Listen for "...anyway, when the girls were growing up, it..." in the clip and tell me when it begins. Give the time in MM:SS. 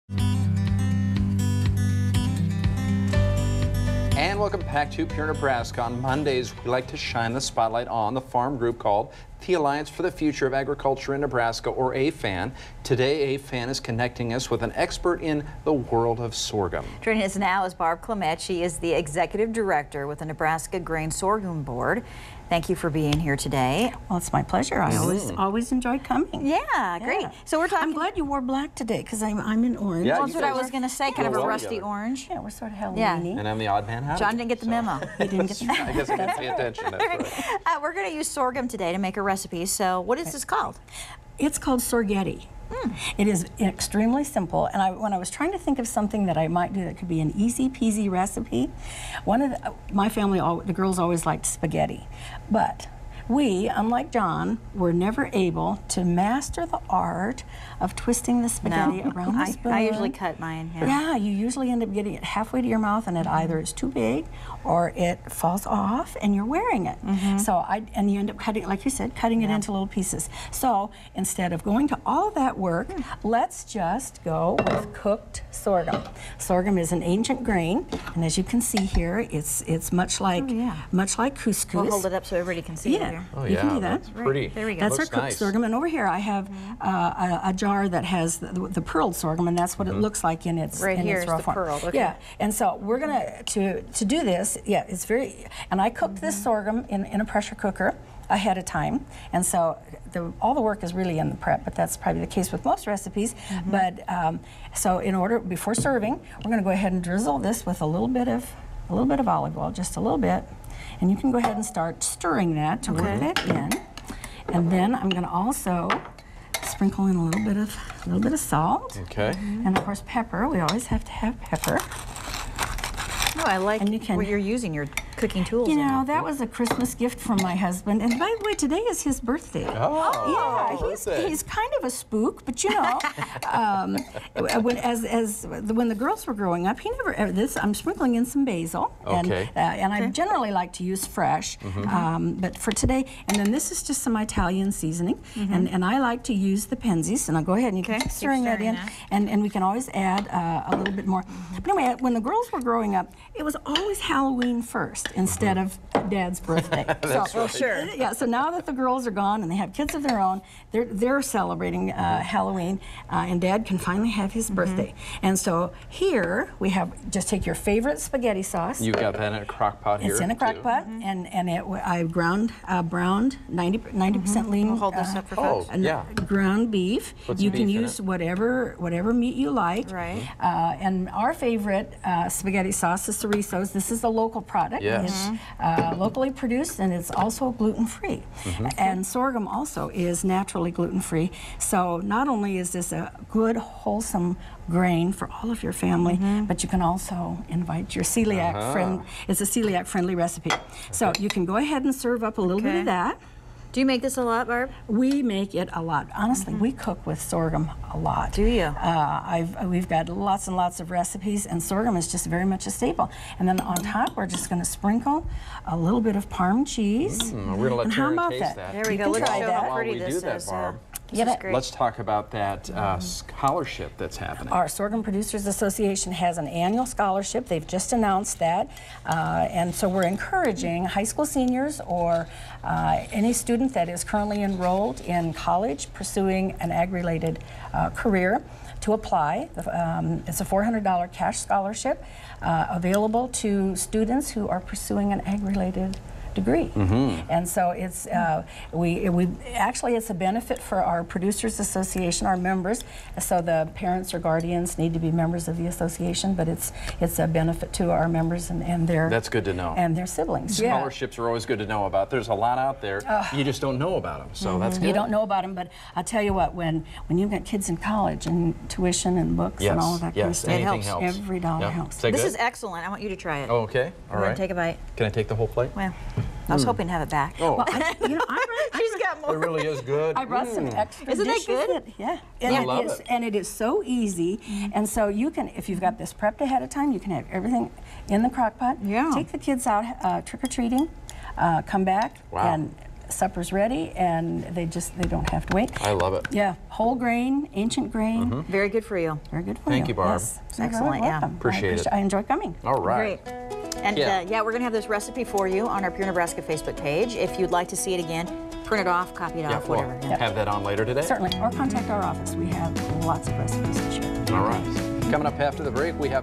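02:31.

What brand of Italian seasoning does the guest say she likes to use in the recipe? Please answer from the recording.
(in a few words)
Penzeys.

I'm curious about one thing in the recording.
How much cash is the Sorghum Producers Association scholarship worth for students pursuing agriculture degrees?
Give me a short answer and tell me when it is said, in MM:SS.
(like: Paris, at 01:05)
$400, at 04:00.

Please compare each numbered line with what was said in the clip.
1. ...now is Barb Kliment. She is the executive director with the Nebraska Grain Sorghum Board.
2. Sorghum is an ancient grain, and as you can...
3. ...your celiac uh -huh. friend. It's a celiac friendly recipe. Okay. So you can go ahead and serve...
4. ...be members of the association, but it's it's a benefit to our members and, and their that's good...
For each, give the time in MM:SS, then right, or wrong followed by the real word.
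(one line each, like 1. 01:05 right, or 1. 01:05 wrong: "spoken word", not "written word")
1. 00:17 right
2. 01:16 right
3. 03:17 right
4. 04:14 right.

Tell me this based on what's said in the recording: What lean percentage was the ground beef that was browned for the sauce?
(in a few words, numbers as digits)
90%.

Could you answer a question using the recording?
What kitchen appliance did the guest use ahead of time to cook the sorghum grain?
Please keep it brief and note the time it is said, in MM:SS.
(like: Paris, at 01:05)
Pressure cooker, at 01:37.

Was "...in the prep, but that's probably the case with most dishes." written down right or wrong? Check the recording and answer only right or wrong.
wrong.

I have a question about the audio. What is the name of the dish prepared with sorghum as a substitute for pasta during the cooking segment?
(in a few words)
Sorghetti.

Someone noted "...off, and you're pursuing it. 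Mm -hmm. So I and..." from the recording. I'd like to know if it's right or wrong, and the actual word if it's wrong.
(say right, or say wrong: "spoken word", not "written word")
wrong: "wearing", not "pursuing".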